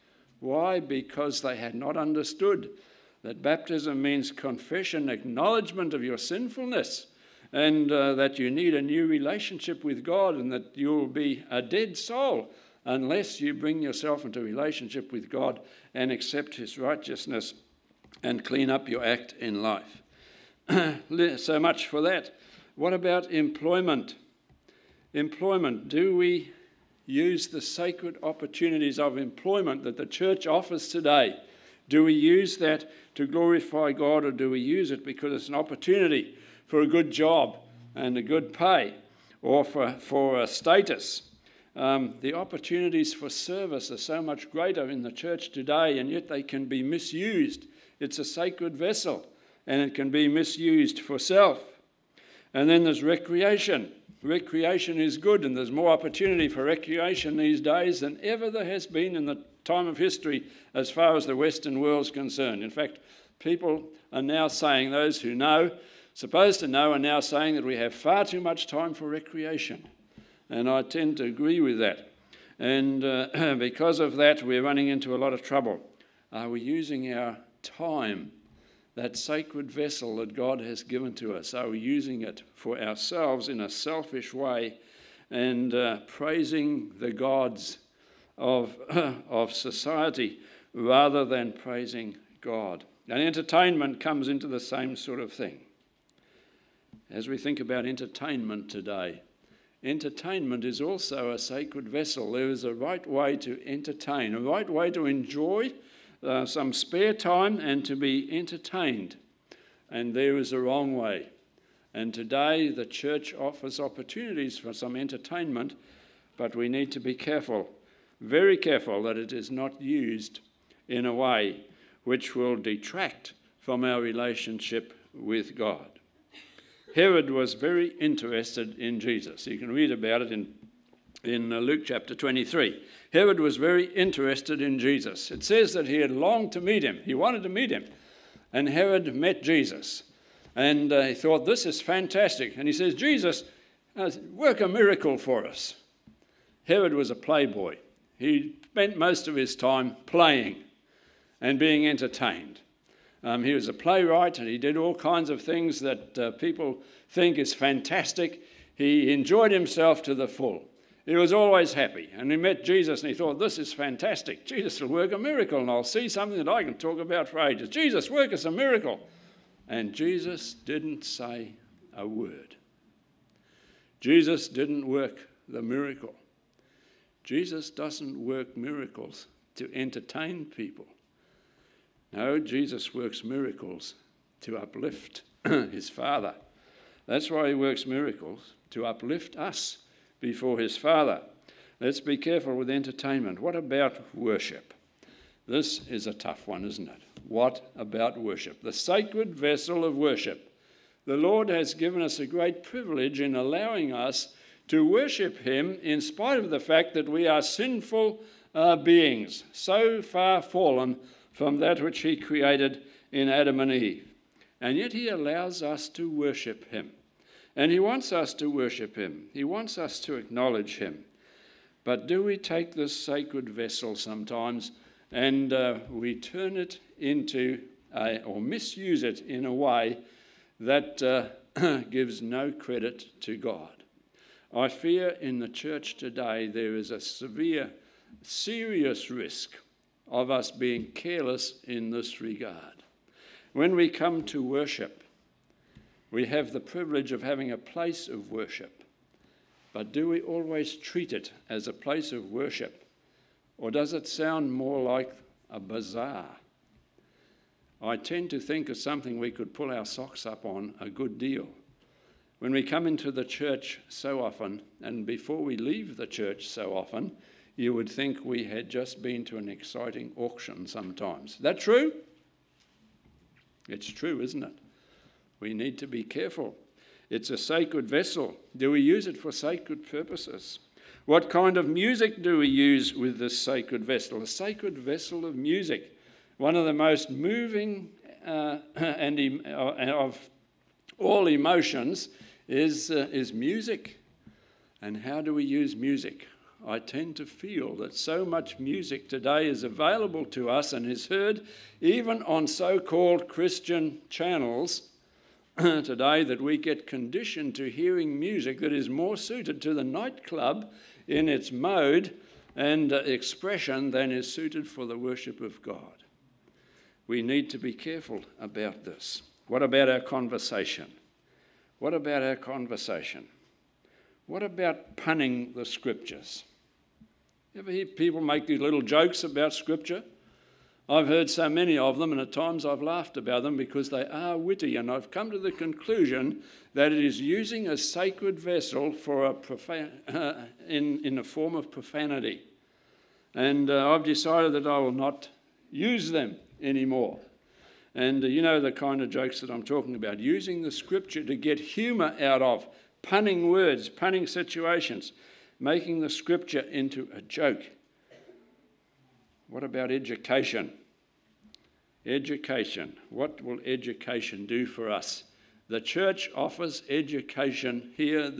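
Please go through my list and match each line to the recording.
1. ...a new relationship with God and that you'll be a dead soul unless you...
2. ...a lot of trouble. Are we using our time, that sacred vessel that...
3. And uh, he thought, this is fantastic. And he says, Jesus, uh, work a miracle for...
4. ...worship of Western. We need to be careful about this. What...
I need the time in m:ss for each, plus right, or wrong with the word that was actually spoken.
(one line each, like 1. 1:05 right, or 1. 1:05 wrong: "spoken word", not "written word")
1. 0:08 right
2. 1:15 right
3. 2:20 right
4. 5:14 wrong: "God", not "Western".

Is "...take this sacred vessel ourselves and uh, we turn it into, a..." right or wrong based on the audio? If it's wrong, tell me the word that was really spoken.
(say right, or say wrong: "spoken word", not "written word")
wrong: "sometimes", not "ourselves".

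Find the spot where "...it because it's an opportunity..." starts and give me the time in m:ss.
0:34.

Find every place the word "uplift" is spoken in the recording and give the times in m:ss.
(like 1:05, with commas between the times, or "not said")
3:04, 3:08.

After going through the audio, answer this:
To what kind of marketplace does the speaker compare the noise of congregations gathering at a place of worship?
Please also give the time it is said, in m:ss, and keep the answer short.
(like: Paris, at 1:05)
A bazaar, at 4:15.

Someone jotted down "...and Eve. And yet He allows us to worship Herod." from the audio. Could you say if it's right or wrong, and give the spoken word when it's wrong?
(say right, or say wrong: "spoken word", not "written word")
wrong: "Him", not "Herod".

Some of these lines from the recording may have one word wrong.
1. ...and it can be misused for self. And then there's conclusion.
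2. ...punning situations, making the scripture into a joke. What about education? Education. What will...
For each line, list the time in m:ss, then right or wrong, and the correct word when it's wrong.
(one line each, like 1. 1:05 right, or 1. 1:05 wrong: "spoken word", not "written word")
1. 0:49 wrong: "recreation", not "conclusion"
2. 5:53 right.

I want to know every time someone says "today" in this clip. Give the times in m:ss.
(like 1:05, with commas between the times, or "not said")
0:30, 0:45, 1:38, 1:52, 3:55, 4:59, 5:05.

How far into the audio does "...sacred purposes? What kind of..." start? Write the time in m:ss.
4:39.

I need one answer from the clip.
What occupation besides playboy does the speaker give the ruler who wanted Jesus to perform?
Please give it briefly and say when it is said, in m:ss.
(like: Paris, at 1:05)
Playwright, at 2:33.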